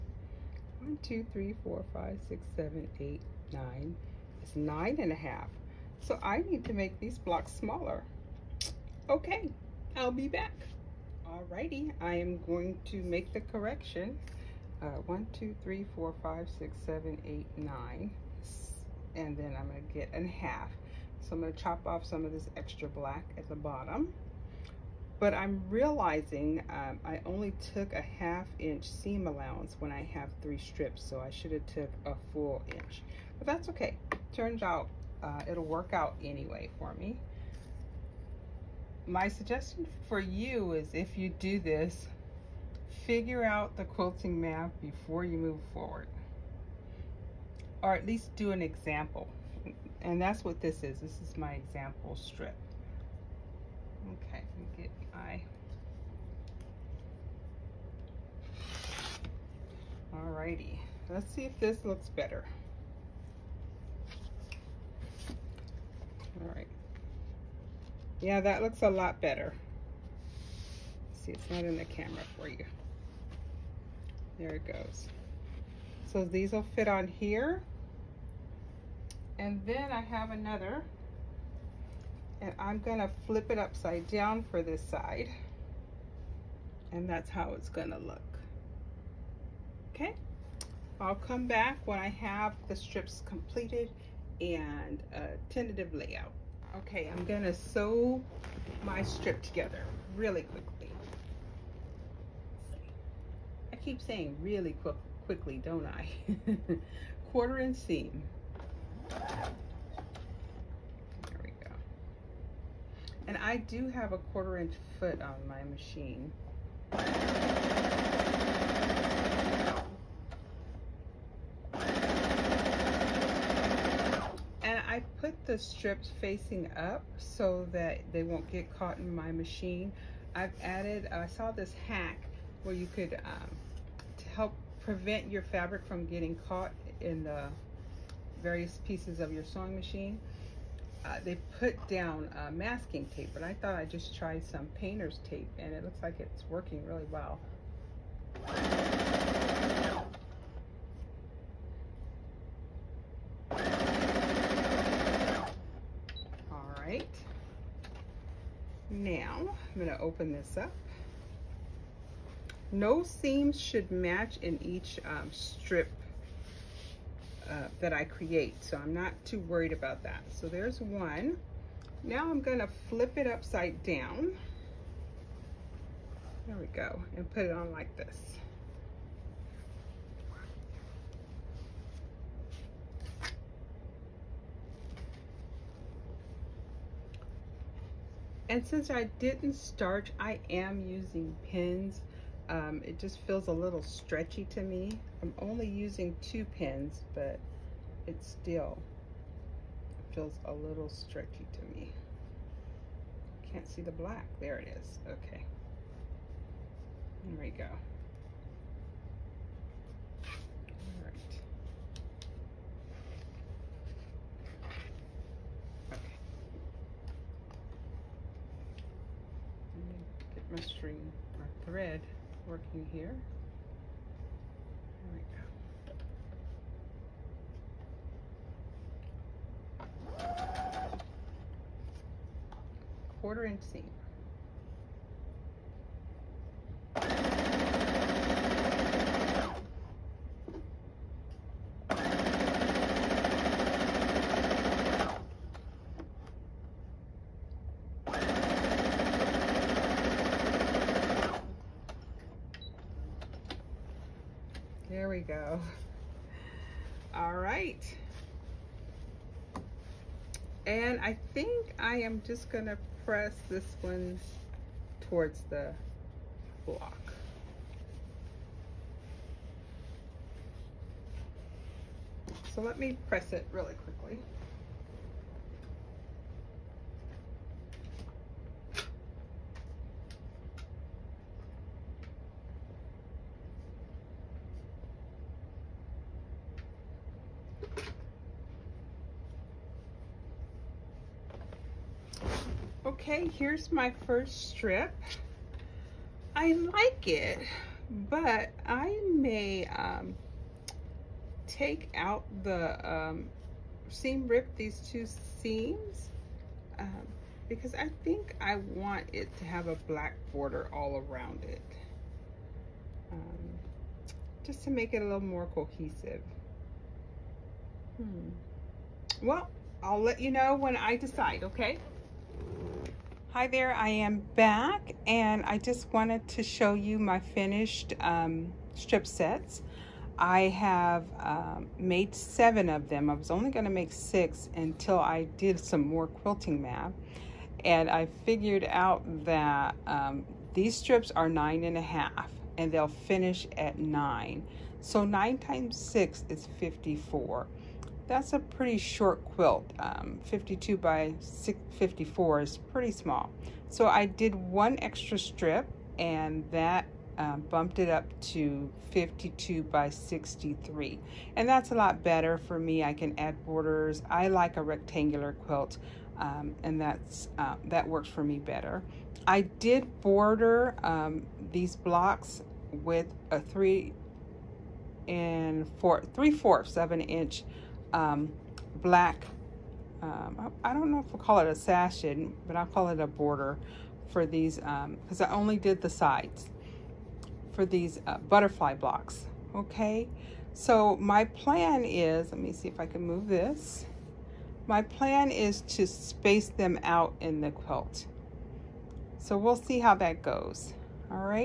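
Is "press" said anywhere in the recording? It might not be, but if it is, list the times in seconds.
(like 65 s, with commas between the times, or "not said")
263 s, 273 s.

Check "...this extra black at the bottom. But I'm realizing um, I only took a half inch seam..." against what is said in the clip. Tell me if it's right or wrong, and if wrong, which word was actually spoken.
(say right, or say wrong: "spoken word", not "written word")
right.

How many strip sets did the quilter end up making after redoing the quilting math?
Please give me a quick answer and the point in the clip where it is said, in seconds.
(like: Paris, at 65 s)
7, at 332 s.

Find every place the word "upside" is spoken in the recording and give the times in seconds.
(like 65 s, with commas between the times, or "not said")
83 s, 173 s.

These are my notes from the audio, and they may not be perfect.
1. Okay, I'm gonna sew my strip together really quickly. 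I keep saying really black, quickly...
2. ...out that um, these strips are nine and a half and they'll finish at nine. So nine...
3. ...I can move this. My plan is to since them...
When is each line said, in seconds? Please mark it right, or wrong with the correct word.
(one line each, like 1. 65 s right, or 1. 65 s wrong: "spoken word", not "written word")
1. 96 s wrong: "quick", not "black"
2. 338 s right
3. 392 s wrong: "space", not "since".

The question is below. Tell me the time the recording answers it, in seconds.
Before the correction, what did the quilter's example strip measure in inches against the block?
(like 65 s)
4 s.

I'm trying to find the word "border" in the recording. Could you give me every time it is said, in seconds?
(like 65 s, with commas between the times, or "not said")
310 s, 363 s, 370 s, 383 s.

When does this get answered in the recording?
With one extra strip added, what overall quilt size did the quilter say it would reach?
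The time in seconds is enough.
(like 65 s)
358 s.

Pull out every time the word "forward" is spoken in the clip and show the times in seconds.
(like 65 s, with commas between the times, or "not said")
45 s.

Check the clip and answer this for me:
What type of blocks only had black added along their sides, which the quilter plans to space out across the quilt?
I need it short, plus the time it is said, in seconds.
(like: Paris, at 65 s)
butterfly blocks, at 388 s.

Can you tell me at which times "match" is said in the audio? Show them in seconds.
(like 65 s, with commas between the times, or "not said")
163 s.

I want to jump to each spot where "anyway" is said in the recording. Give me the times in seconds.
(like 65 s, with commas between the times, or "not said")
36 s.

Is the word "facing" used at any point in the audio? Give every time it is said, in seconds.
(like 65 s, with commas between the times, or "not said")
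126 s.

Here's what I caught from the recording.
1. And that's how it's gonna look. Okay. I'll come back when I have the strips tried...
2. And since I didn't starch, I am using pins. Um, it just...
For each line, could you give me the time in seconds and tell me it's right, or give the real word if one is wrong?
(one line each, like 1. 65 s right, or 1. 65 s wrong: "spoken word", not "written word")
1. 86 s wrong: "completed", not "tried"
2. 188 s right.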